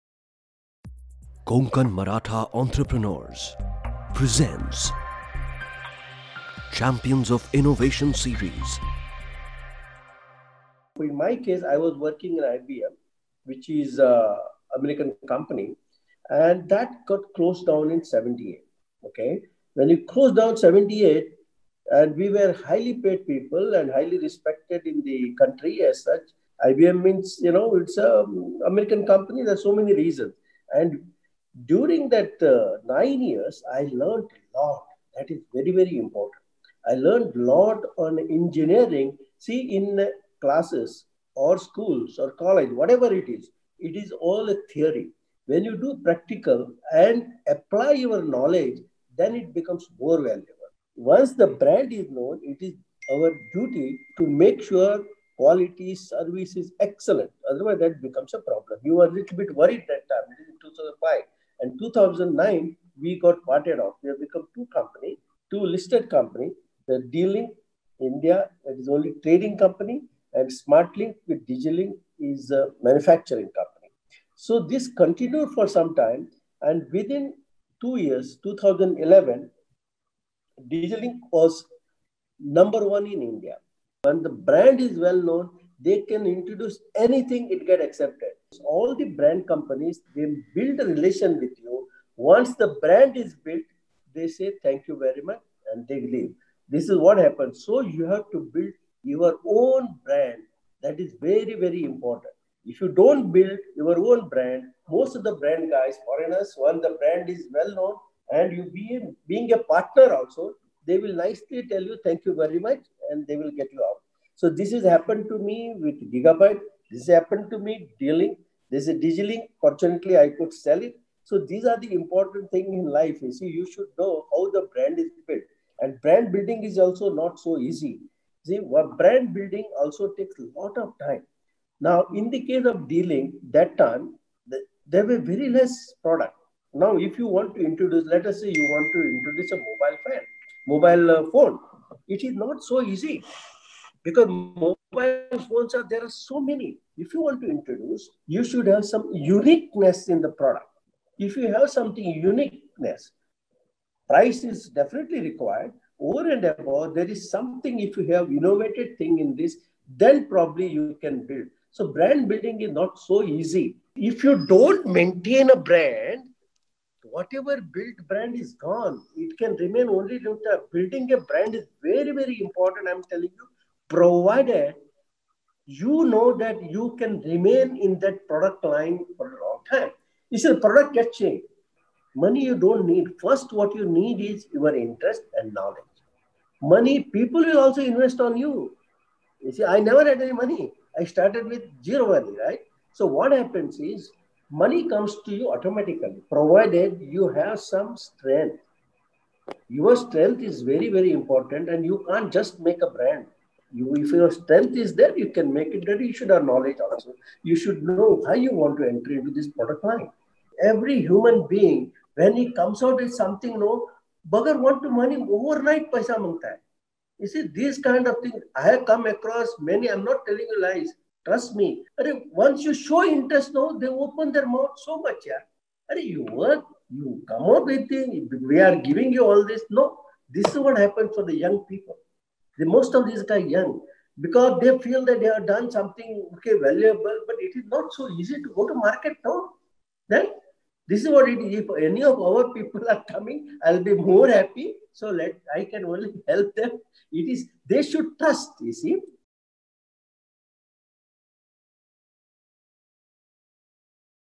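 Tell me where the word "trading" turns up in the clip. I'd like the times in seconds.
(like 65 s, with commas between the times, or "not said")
69 s.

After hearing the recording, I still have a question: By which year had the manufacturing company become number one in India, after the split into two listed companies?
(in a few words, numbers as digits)
2011.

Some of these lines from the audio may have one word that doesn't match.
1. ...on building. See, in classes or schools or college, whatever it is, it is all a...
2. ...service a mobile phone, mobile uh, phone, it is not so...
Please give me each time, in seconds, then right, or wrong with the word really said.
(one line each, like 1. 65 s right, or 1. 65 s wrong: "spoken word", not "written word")
1. 37 s wrong: "engineering", not "building"
2. 139 s wrong: "introduce", not "service".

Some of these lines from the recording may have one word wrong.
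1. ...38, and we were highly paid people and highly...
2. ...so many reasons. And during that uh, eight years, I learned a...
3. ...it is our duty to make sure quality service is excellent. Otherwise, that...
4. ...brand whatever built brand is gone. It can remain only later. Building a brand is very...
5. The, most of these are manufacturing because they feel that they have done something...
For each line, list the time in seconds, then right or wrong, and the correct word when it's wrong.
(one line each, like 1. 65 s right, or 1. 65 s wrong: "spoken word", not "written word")
1. 20 s wrong: "78", not "38"
2. 29 s wrong: "nine", not "eight"
3. 52 s right
4. 165 s right
5. 232 s wrong: "young", not "manufacturing".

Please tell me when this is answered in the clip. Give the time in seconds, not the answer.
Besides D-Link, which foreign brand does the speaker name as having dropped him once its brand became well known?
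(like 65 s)
116 s.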